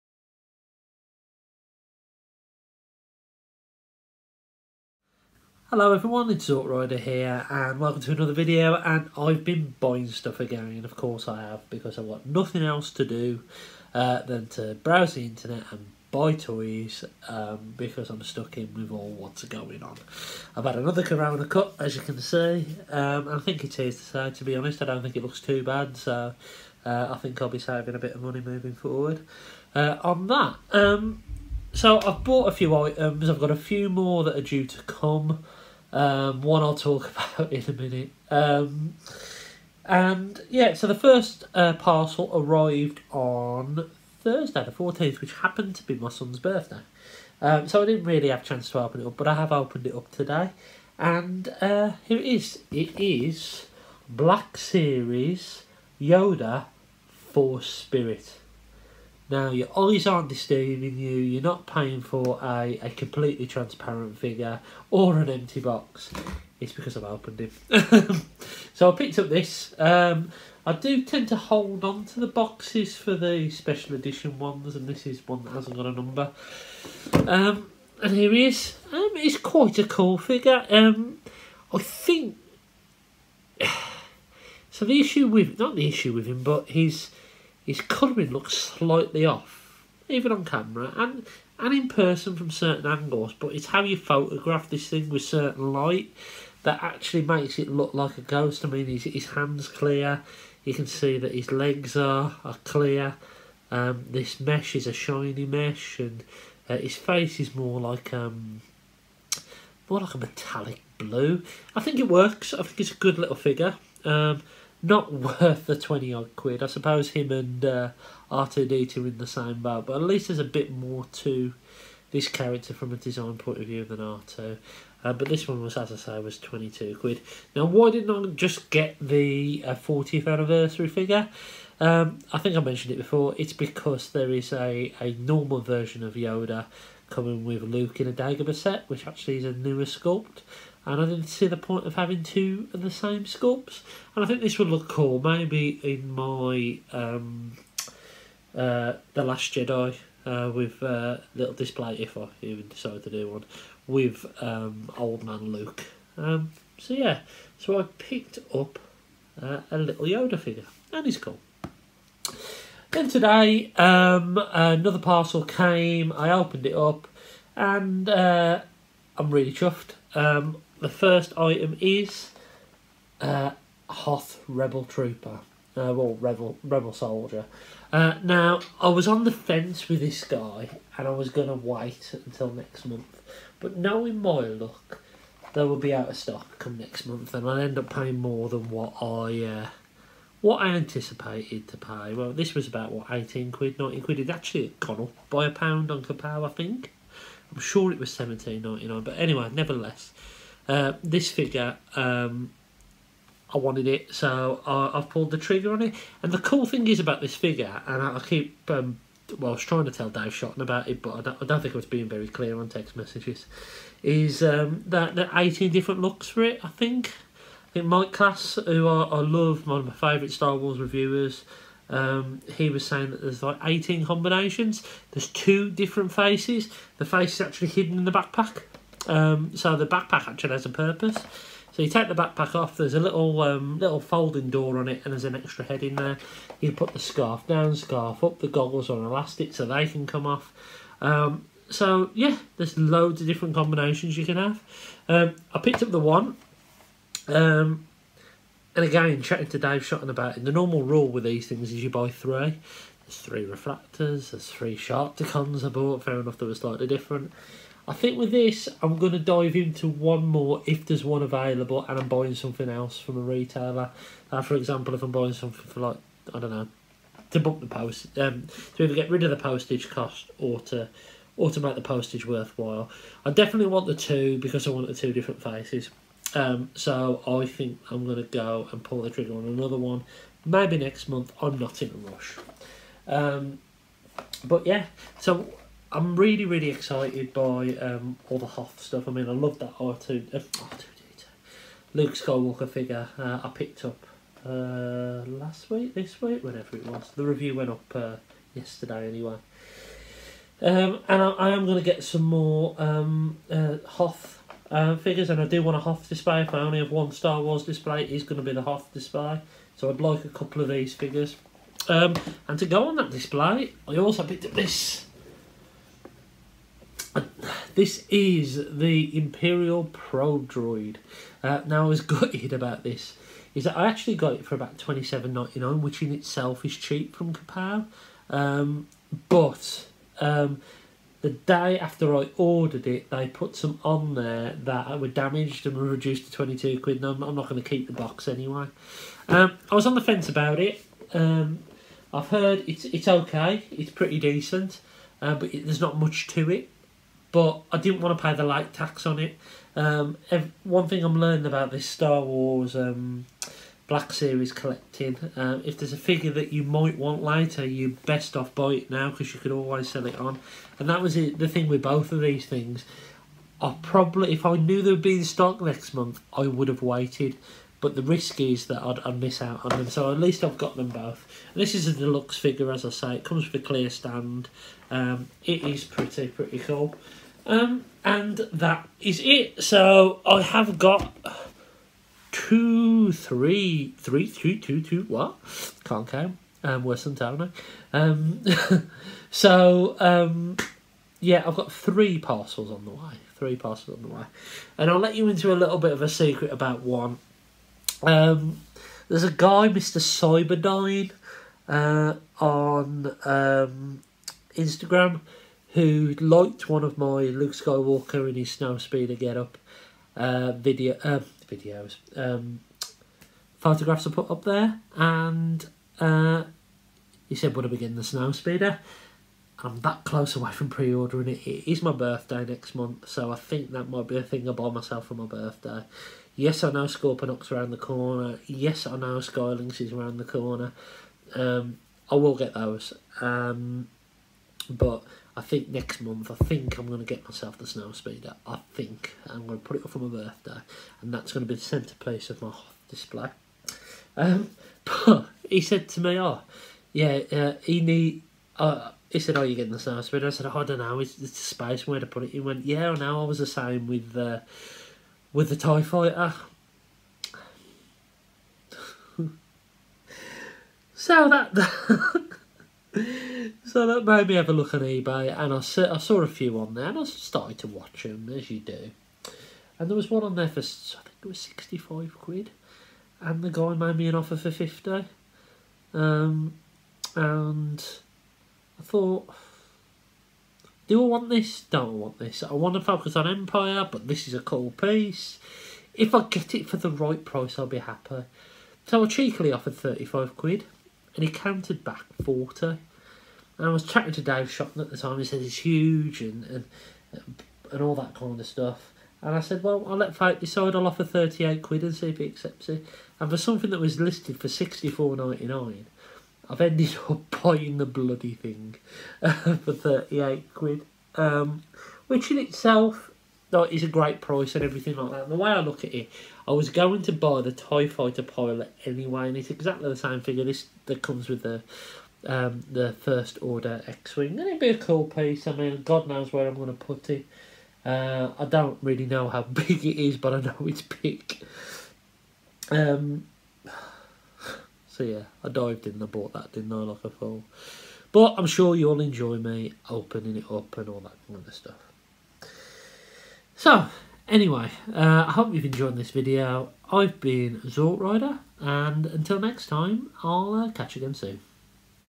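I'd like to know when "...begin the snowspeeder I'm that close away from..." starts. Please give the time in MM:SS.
06:57.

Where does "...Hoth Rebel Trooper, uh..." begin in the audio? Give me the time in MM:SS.
02:53.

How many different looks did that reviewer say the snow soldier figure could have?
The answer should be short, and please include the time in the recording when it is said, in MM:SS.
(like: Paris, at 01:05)
18, at 03:43.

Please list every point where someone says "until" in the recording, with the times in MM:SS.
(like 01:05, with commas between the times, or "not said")
03:02, 09:09.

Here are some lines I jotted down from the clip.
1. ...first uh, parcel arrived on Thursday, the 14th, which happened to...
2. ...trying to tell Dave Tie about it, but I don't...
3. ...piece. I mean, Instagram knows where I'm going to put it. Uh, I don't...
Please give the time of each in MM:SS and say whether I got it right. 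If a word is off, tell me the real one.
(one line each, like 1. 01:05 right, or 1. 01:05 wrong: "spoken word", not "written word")
1. 00:40 right
2. 03:29 wrong: "Shotton", not "Tie"
3. 08:45 wrong: "God", not "Instagram".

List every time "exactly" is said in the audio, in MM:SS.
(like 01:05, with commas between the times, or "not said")
08:39.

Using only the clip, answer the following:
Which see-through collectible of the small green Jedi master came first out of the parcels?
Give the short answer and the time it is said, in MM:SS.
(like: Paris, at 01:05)
Black Series Yoda Force Spirit, at 00:54.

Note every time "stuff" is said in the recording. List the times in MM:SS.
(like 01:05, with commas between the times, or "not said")
00:10, 04:48, 08:18, 09:01.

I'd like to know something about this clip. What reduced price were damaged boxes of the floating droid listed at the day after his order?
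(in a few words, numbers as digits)
£22.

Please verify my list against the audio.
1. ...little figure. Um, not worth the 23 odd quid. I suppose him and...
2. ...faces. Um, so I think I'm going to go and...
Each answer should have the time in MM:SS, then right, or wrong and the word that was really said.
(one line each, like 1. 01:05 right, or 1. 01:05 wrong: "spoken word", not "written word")
1. 01:53 wrong: "20", not "23"
2. 04:35 right.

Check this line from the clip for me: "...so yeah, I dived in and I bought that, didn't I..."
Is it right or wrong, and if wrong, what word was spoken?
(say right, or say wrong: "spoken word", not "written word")
right.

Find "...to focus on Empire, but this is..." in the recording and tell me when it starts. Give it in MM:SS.
08:02.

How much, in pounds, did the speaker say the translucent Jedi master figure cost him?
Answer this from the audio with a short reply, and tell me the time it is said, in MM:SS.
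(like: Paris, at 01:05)
22, at 02:06.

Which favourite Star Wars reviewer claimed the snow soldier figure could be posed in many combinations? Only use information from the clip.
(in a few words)
Mike Class.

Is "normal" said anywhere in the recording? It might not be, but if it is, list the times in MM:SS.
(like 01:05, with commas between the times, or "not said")
02:15, 04:10.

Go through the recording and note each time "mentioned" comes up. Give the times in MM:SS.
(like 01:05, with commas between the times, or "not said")
02:12.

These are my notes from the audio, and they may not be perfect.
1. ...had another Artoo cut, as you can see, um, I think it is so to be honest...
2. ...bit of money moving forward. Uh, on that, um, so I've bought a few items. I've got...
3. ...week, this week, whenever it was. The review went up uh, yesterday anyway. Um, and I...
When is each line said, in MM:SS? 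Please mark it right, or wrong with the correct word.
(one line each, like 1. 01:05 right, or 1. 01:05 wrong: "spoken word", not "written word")
1. 00:20 wrong: "Corona", not "Artoo"
2. 00:27 right
3. 04:55 right.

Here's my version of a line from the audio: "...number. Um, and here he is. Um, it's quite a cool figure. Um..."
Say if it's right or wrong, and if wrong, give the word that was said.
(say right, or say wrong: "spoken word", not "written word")
right.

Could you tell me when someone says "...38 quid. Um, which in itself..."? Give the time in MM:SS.
08:29.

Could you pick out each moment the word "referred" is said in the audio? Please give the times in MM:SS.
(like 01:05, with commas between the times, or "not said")
not said.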